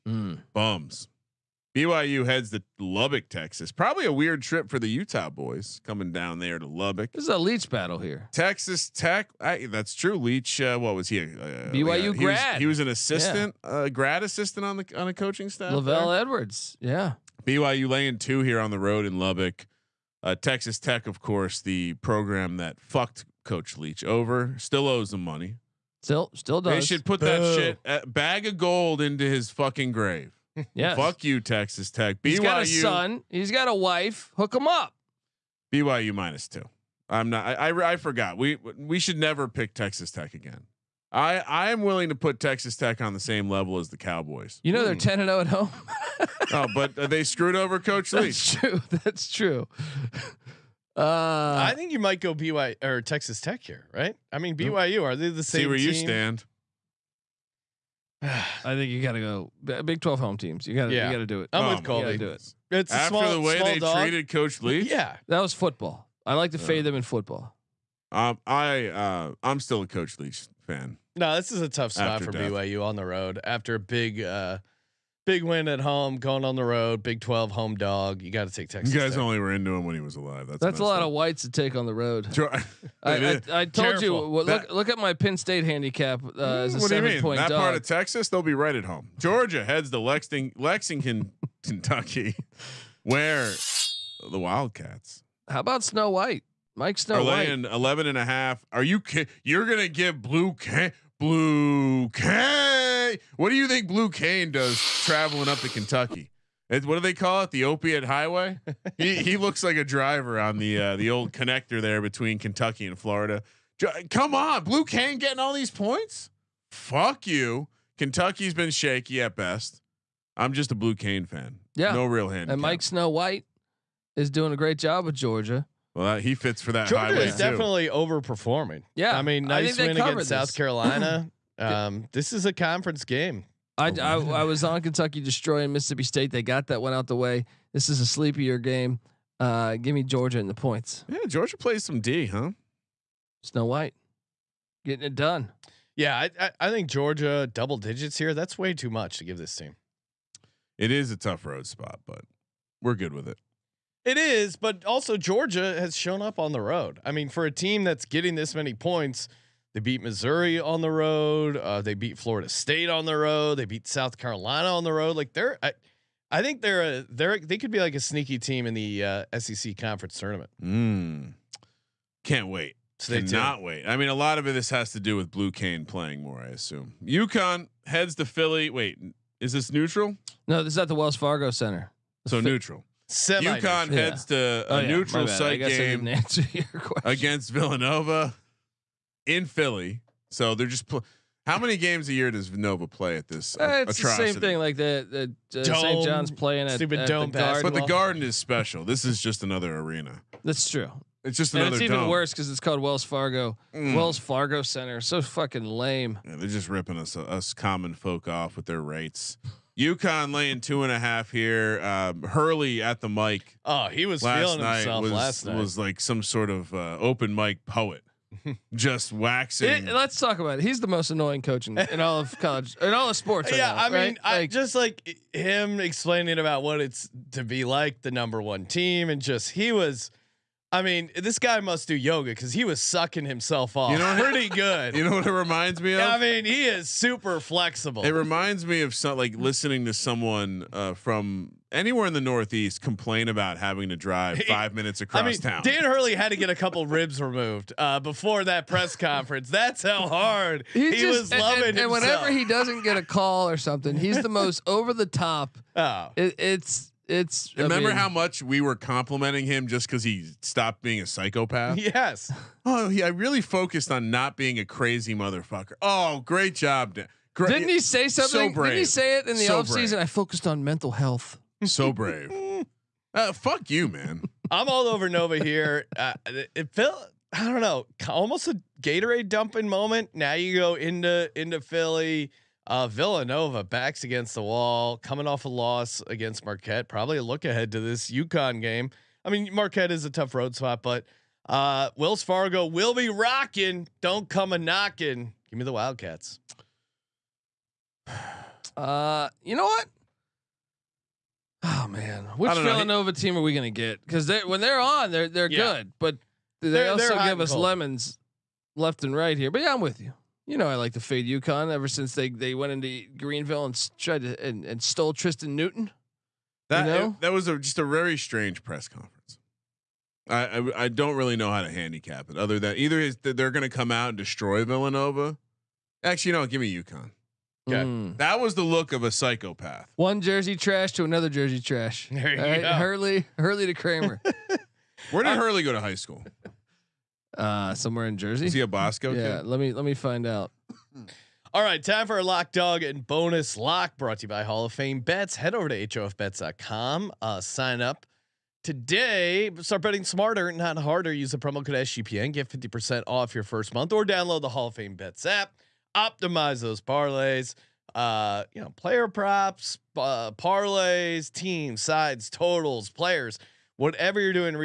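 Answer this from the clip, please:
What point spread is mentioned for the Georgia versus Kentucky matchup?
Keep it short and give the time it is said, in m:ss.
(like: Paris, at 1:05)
11.5, at 1:37.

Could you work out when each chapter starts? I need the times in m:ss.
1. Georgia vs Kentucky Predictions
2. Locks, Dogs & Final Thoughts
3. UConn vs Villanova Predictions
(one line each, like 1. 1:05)
1. 1:31
2. 5:42
3. 2:57.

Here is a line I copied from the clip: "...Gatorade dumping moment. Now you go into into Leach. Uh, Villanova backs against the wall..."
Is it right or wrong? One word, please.
wrong.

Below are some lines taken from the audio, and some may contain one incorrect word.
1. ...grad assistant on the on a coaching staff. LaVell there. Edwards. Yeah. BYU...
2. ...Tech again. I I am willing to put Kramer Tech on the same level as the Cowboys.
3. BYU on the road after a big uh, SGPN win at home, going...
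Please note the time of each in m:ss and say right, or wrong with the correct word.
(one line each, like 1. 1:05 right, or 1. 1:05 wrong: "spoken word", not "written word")
1. 0:13 right
2. 0:40 wrong: "Texas", not "Kramer"
3. 1:12 wrong: "Big", not "SGPN".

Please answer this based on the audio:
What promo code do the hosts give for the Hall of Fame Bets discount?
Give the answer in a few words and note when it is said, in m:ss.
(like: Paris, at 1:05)
SGPN, at 5:51.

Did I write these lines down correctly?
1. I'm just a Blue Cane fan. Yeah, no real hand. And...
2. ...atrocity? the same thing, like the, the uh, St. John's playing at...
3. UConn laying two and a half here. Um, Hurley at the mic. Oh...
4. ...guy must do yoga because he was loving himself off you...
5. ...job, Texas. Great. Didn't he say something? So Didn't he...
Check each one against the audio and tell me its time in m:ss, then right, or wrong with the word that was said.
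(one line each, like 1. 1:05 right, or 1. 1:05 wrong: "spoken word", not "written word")
1. 2:00 right
2. 3:13 right
3. 3:29 right
4. 3:51 wrong: "sucking", not "loving"
5. 4:26 wrong: "Dan", not "Texas".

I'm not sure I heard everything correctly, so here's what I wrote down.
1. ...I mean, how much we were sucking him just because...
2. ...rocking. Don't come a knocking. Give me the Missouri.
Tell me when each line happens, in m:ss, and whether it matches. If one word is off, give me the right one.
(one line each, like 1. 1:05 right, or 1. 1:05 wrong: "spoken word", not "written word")
1. 4:17 wrong: "complimenting", not "sucking"
2. 4:53 wrong: "Wildcats", not "Missouri".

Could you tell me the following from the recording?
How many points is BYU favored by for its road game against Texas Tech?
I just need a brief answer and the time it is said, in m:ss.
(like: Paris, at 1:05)
2, at 0:35.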